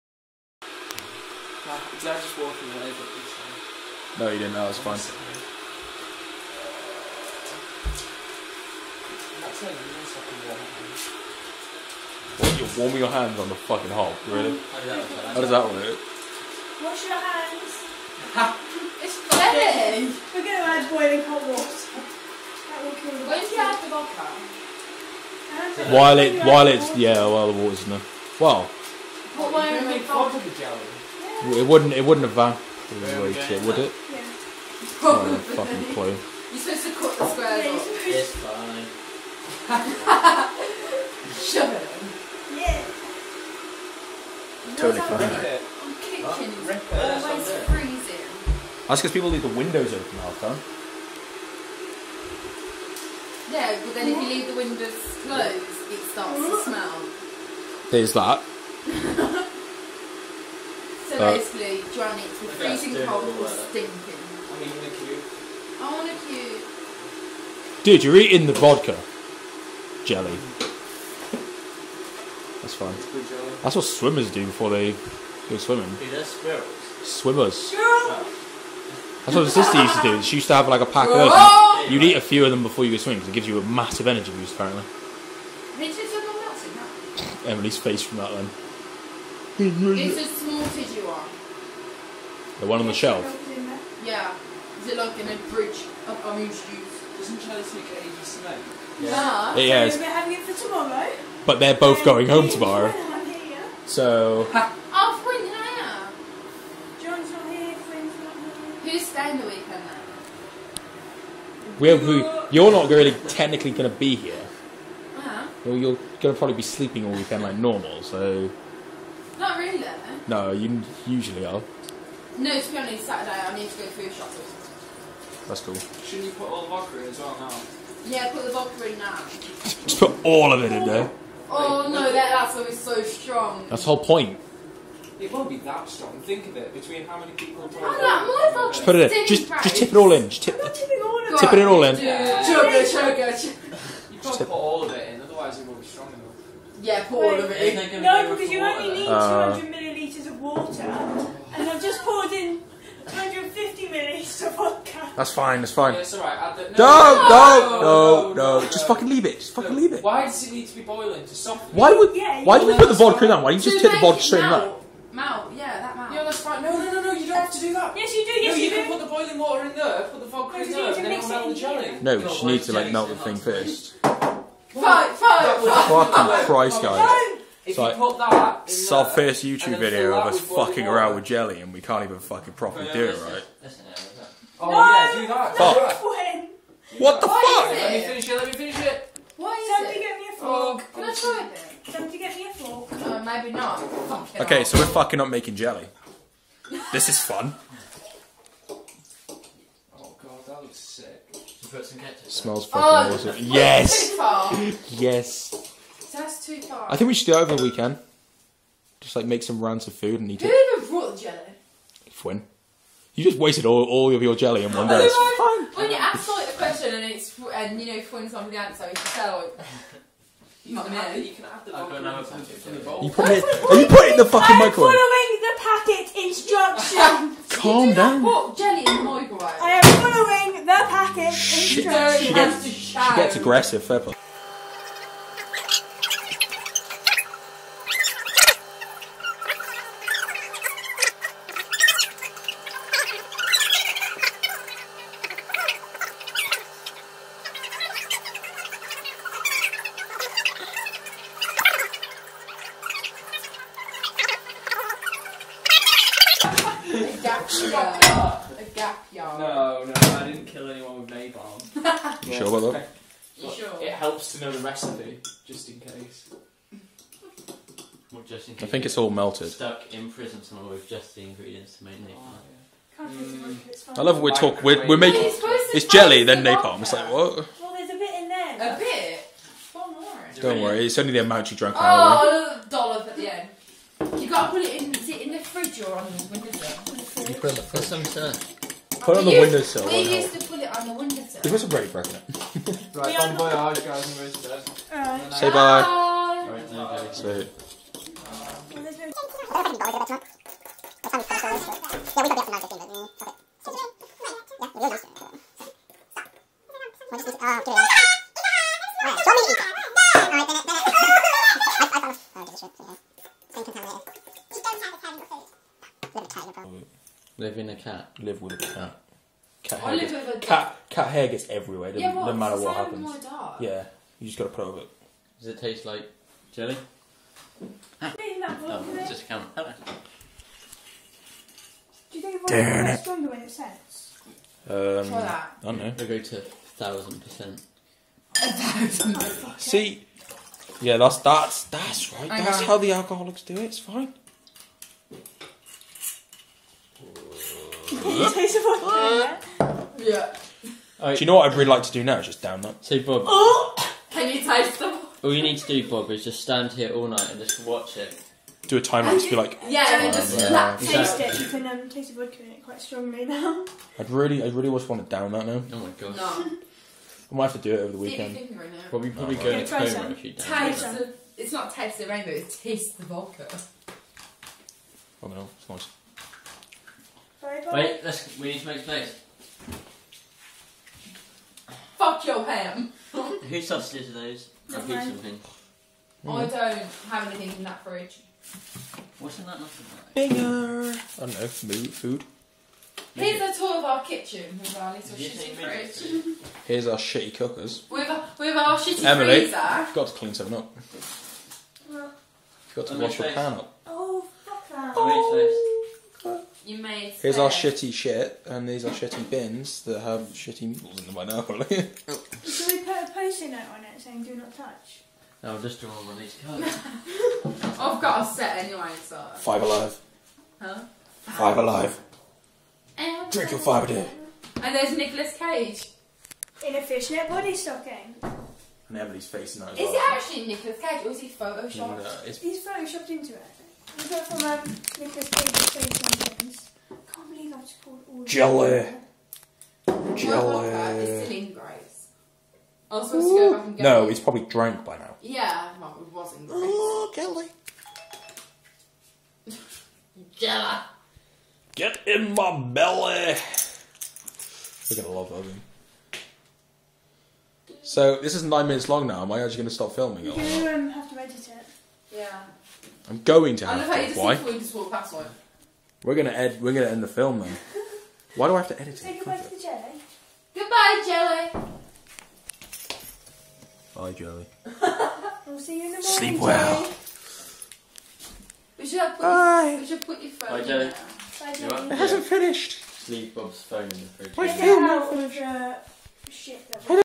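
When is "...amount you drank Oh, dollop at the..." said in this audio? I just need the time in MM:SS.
04:41.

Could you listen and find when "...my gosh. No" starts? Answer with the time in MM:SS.
06:05.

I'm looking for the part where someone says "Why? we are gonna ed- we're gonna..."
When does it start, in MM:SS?
07:44.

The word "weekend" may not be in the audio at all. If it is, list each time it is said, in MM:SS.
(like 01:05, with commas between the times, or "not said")
01:49, 01:57, 03:27, 06:07.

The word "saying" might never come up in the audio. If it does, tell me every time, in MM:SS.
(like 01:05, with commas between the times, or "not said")
06:54.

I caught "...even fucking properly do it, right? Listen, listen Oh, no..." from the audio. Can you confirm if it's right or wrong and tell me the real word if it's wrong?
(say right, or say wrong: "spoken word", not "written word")
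right.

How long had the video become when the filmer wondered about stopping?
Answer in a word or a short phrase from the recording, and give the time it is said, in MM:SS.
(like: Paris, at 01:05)
9 minutes, at 07:38.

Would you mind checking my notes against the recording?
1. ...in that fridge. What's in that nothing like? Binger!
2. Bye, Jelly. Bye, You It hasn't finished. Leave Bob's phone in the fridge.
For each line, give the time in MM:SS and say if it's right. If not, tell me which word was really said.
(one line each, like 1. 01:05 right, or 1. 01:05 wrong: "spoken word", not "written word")
1. 06:27 right
2. 08:00 right.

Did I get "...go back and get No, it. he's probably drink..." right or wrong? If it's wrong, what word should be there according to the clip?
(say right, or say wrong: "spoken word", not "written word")
wrong: "drunk", not "drink".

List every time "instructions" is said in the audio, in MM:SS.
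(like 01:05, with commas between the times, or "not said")
03:46, 03:51.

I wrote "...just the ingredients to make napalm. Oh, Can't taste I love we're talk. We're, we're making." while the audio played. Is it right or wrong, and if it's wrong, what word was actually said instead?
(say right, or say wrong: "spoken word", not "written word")
right.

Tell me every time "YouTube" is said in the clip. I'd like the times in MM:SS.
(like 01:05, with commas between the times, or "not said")
02:59.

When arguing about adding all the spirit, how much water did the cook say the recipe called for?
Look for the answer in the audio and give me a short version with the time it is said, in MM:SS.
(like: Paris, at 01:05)
200 millilitres, at 02:29.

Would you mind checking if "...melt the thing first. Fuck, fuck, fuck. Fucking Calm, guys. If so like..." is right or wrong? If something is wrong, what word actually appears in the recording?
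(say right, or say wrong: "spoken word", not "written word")
wrong: "Christ", not "Calm".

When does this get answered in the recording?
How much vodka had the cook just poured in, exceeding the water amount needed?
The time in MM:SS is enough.
02:33.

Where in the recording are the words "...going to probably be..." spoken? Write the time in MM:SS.
01:56.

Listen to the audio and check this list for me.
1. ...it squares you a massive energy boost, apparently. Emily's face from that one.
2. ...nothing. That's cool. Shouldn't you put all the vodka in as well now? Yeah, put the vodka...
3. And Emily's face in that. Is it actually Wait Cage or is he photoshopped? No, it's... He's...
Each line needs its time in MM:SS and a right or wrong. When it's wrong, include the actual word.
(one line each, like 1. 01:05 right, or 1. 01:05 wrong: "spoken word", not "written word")
1. 01:23 wrong: "gives", not "squares"
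2. 02:04 wrong: "shopping", not "nothing"
3. 07:08 wrong: "Nicolas", not "Wait".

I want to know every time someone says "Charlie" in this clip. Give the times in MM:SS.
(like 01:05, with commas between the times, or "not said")
01:37.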